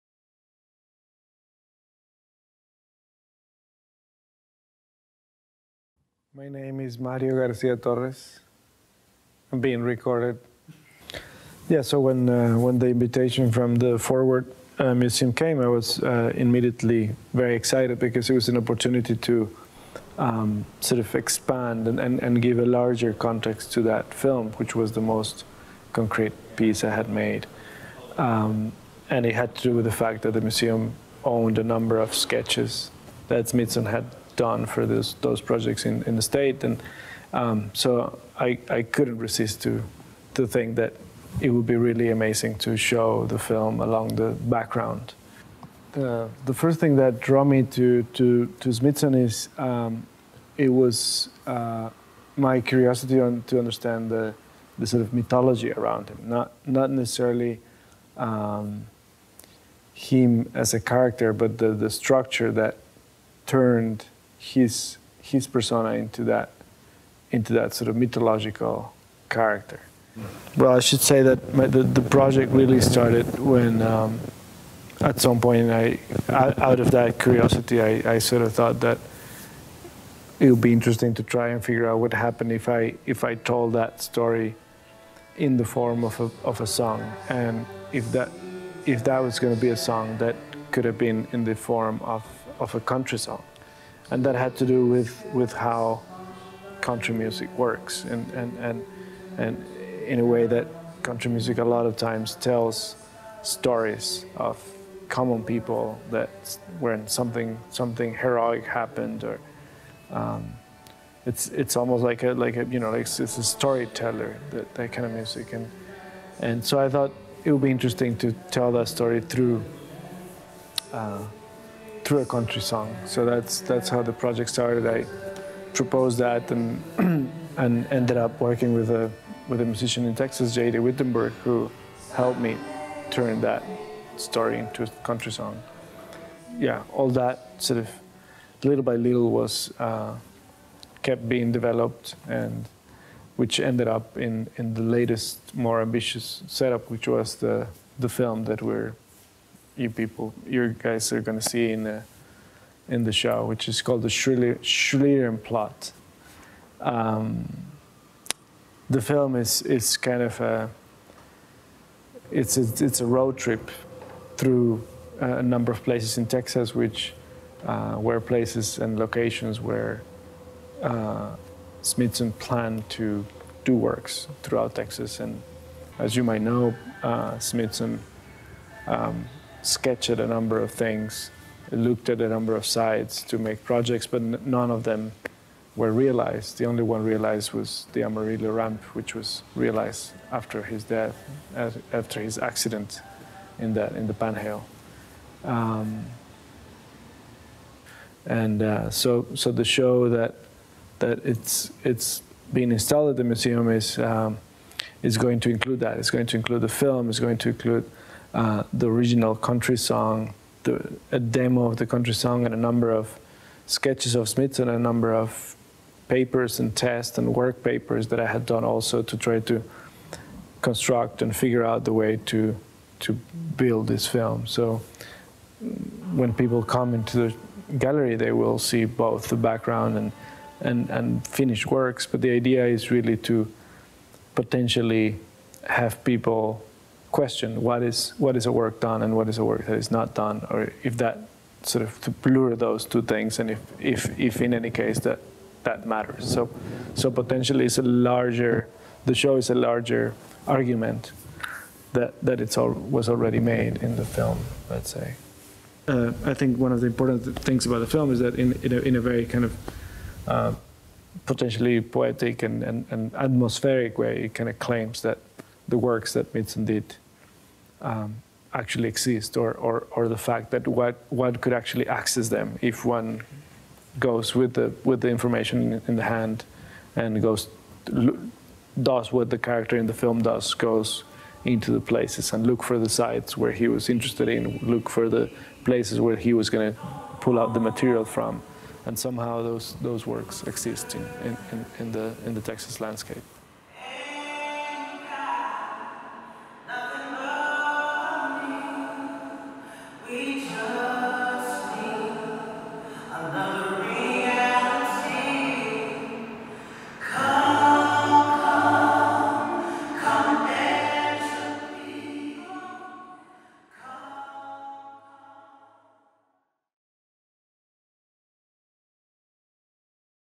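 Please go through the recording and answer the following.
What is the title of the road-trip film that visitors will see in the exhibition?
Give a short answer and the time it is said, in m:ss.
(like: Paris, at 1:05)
The Schlieren Plot, at 2:34.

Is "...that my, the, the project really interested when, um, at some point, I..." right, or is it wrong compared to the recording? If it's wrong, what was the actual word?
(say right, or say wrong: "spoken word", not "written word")
wrong: "started", not "interested".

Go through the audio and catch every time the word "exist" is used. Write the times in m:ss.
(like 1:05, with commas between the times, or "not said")
4:28, 4:50.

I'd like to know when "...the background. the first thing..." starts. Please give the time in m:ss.
0:44.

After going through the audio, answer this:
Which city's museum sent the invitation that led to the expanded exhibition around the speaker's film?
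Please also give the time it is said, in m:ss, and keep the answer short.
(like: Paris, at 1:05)
Fort Worth, at 0:13.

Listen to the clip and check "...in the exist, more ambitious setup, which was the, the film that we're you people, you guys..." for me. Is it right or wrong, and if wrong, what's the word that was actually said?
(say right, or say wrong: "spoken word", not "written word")
wrong: "latest", not "exist".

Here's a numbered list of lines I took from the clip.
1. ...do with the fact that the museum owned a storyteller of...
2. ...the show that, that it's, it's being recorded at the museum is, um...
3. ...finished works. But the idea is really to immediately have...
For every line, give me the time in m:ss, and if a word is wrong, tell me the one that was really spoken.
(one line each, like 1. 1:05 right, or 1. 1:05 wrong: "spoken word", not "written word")
1. 0:29 wrong: "number", not "storyteller"
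2. 3:19 wrong: "installed", not "recorded"
3. 3:51 wrong: "potentially", not "immediately".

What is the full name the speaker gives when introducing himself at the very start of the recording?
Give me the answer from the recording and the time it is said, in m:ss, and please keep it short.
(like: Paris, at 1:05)
Mario Garcia Torres, at 0:06.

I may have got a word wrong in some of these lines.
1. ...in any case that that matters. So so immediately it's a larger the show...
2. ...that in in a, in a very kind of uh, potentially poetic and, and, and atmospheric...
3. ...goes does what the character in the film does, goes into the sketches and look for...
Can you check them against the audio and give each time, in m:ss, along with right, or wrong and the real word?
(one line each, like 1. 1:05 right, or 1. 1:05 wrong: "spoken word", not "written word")
1. 4:04 wrong: "potentially", not "immediately"
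2. 4:18 right
3. 4:37 wrong: "places", not "sketches".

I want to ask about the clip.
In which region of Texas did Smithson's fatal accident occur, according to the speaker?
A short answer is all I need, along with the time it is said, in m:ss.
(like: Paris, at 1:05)
the Panhandle, at 3:14.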